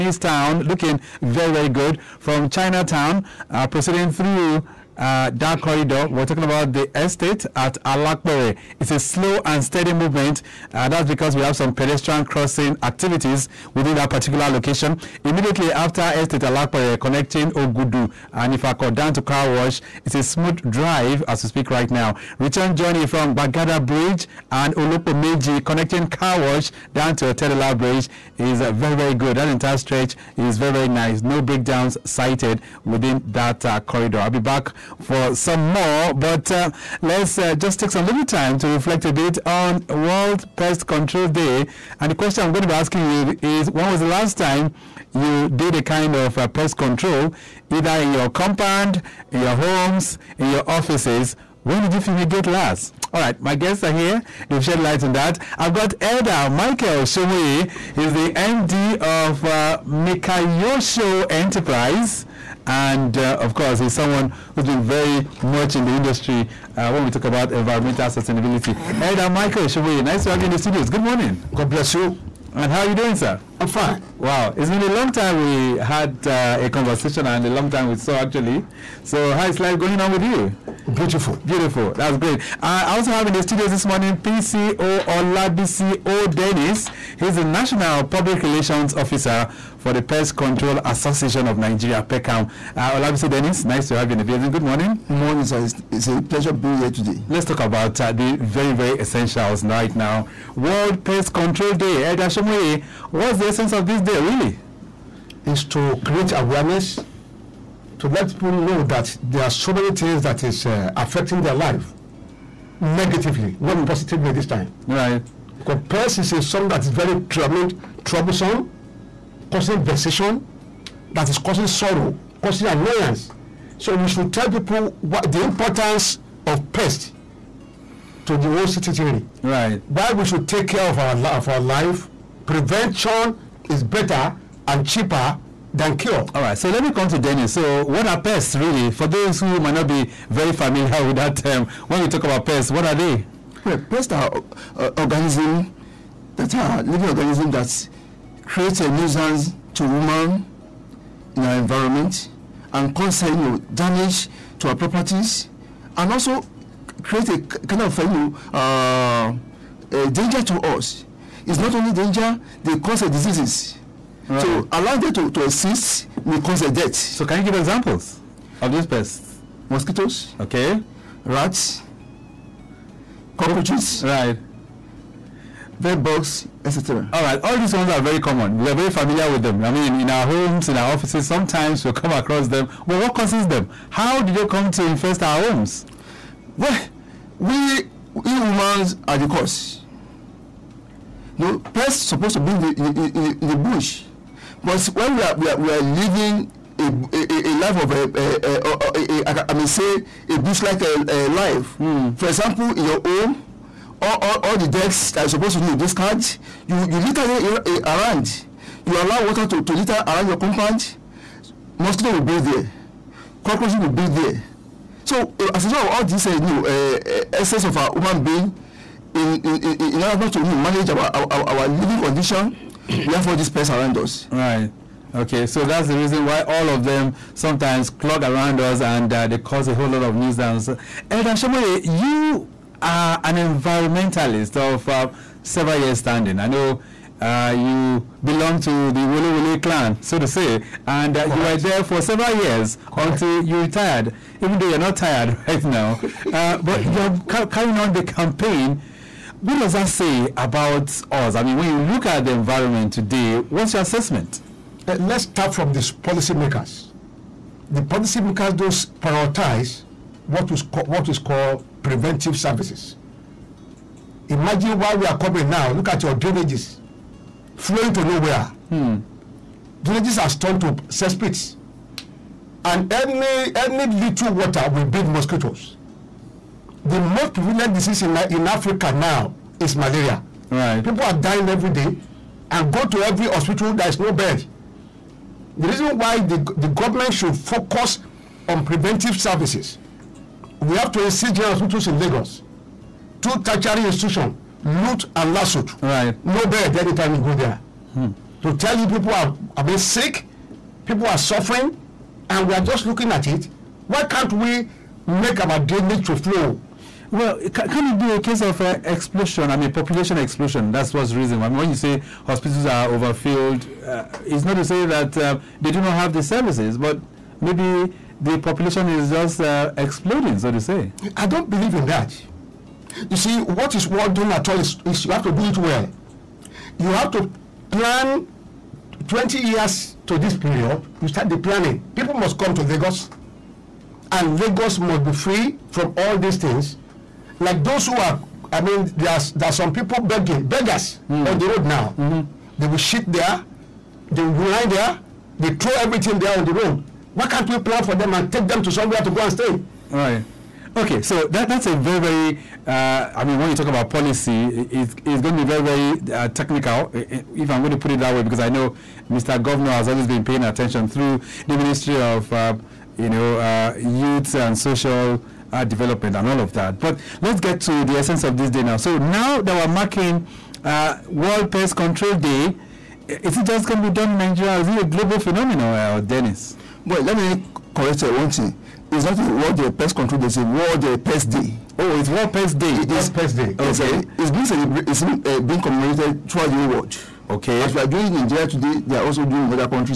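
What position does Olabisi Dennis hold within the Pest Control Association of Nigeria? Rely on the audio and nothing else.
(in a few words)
National Public Relations Officer.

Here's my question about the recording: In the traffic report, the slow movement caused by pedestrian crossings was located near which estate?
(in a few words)
Estate Alapere.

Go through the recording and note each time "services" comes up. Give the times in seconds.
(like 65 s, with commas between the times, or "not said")
262 s, 289 s, 316 s.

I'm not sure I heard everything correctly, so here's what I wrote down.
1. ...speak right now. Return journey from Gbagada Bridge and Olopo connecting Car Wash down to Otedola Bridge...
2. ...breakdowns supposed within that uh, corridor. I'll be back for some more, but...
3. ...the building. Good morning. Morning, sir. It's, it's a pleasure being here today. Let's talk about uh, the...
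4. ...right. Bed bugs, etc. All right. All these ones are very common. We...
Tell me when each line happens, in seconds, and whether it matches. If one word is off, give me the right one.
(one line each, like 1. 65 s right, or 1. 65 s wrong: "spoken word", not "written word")
1. 21 s right
2. 31 s wrong: "cited", not "supposed"
3. 94 s right
4. 174 s right.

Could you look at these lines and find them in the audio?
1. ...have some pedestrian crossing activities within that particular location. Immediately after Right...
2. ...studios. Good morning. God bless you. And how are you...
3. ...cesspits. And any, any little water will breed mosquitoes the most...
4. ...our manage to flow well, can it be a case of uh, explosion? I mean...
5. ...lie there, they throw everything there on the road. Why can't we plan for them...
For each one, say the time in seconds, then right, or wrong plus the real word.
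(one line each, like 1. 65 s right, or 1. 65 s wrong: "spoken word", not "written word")
1. 11 s wrong: "Estate", not "Right"
2. 70 s right
3. 270 s right
4. 305 s wrong: "drainage", not "manage"
5. 344 s right.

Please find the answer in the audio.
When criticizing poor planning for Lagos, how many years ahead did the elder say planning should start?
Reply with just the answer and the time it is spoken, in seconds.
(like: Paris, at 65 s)
20 years, at 329 s.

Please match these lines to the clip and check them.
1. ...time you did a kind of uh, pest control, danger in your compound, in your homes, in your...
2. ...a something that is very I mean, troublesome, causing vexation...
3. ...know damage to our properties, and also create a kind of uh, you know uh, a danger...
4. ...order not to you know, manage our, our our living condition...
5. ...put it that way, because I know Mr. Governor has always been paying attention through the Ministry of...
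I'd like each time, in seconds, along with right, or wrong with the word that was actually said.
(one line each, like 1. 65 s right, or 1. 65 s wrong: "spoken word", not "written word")
1. 44 s wrong: "either", not "danger"
2. 116 s right
3. 153 s right
4. 220 s right
5. 357 s right.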